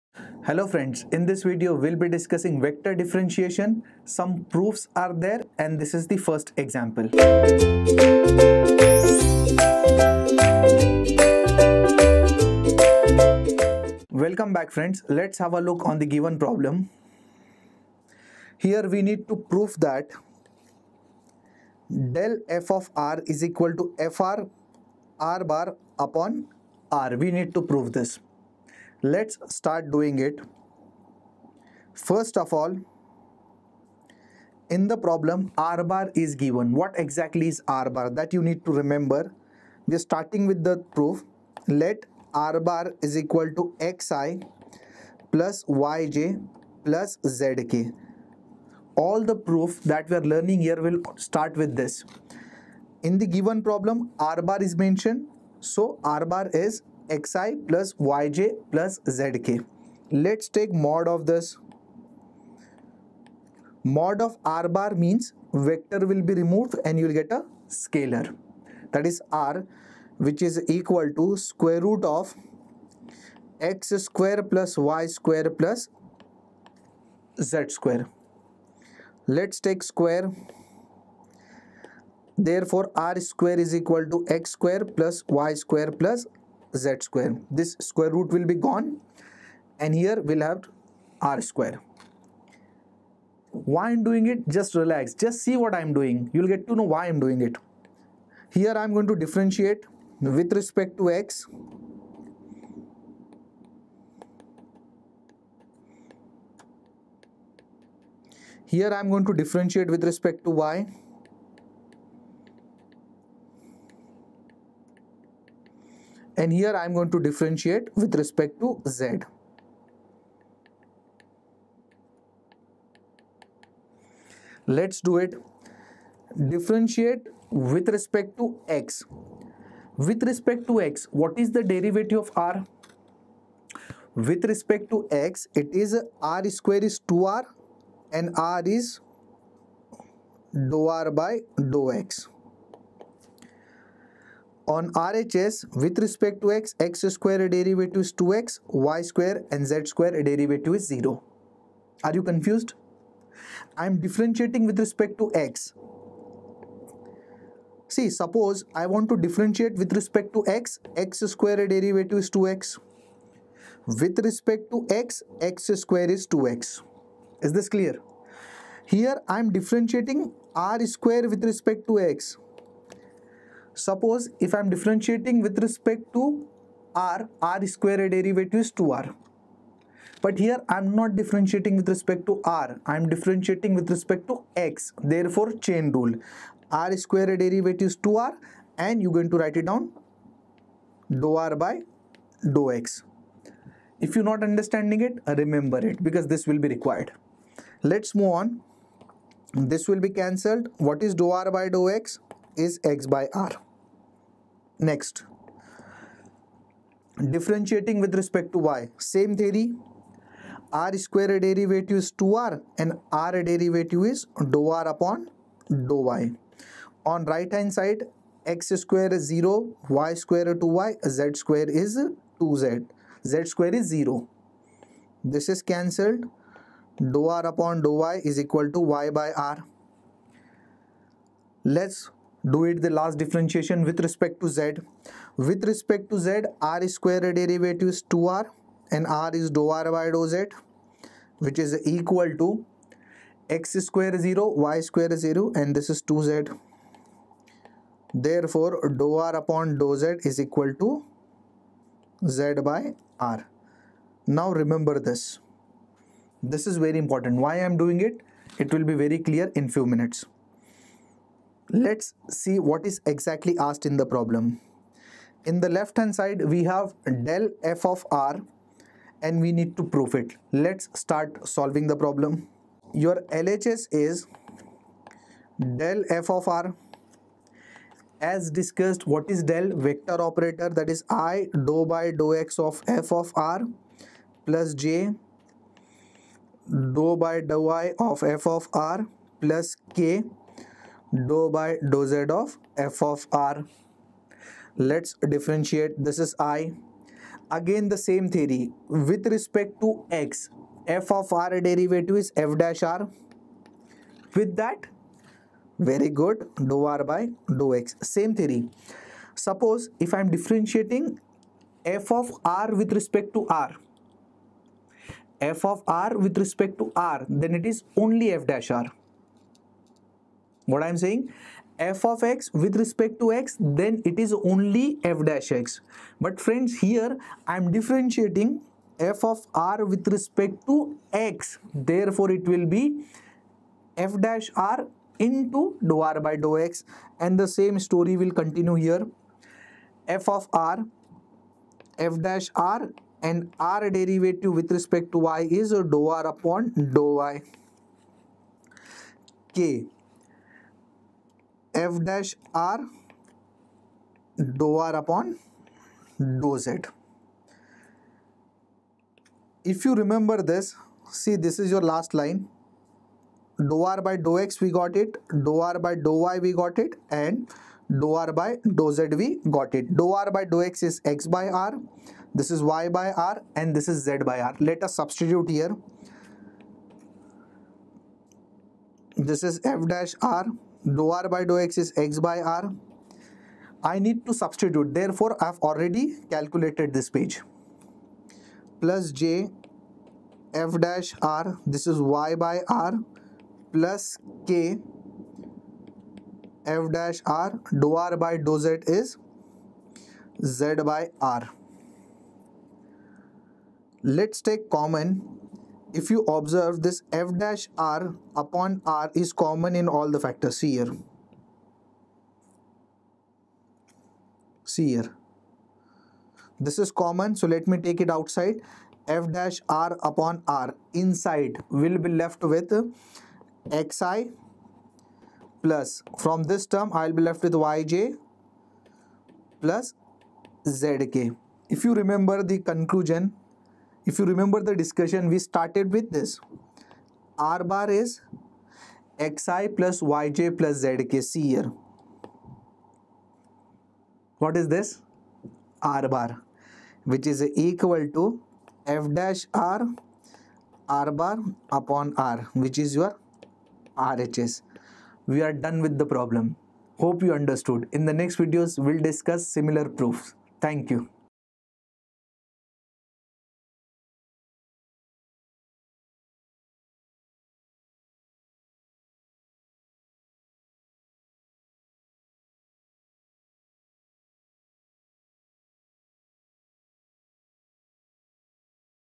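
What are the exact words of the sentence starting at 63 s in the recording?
Mod of r bar means vector will be removed and you will get a scalar.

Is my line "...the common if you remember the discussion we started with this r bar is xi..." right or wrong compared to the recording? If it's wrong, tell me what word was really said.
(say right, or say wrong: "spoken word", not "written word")
wrong: "conclusion", not "common".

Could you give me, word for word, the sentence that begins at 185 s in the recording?
Therefore, chain rule r square derivative is 2r and you're going to write it down dou r by dou x.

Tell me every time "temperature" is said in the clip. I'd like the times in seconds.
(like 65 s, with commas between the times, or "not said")
not said.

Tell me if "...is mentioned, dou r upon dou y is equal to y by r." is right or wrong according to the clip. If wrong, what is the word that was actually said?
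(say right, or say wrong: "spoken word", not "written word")
wrong: "cancelled", not "mentioned".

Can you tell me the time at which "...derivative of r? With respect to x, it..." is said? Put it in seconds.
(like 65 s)
131 s.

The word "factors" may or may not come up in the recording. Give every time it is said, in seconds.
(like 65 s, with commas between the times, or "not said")
410 s.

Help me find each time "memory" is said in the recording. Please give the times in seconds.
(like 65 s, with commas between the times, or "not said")
not said.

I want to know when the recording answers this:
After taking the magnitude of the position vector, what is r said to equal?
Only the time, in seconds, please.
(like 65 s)
71 s.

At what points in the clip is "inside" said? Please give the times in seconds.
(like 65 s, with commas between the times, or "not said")
421 s.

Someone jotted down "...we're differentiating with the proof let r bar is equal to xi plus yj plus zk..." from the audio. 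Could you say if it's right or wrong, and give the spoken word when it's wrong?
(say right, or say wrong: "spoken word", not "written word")
wrong: "starting", not "differentiating".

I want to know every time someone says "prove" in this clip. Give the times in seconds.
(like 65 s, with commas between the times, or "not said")
19 s, 27 s, 269 s.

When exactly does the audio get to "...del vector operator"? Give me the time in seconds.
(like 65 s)
279 s.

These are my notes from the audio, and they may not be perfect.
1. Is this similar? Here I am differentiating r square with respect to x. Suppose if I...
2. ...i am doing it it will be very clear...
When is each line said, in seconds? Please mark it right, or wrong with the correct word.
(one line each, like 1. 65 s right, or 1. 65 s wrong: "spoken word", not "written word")
1. 167 s wrong: "clear", not "similar"
2. 257 s right.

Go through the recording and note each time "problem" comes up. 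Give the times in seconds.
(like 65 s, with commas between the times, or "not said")
16 s, 34 s, 53 s, 264 s, 271 s, 456 s.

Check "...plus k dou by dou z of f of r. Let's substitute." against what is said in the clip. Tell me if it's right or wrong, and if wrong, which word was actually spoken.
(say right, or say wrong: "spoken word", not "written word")
wrong: "differentiate", not "substitute".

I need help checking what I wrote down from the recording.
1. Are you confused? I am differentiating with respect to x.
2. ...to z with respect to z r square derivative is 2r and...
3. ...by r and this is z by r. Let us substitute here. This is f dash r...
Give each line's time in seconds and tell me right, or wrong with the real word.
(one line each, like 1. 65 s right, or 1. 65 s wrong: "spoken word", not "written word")
1. 152 s right
2. 234 s right
3. 372 s right.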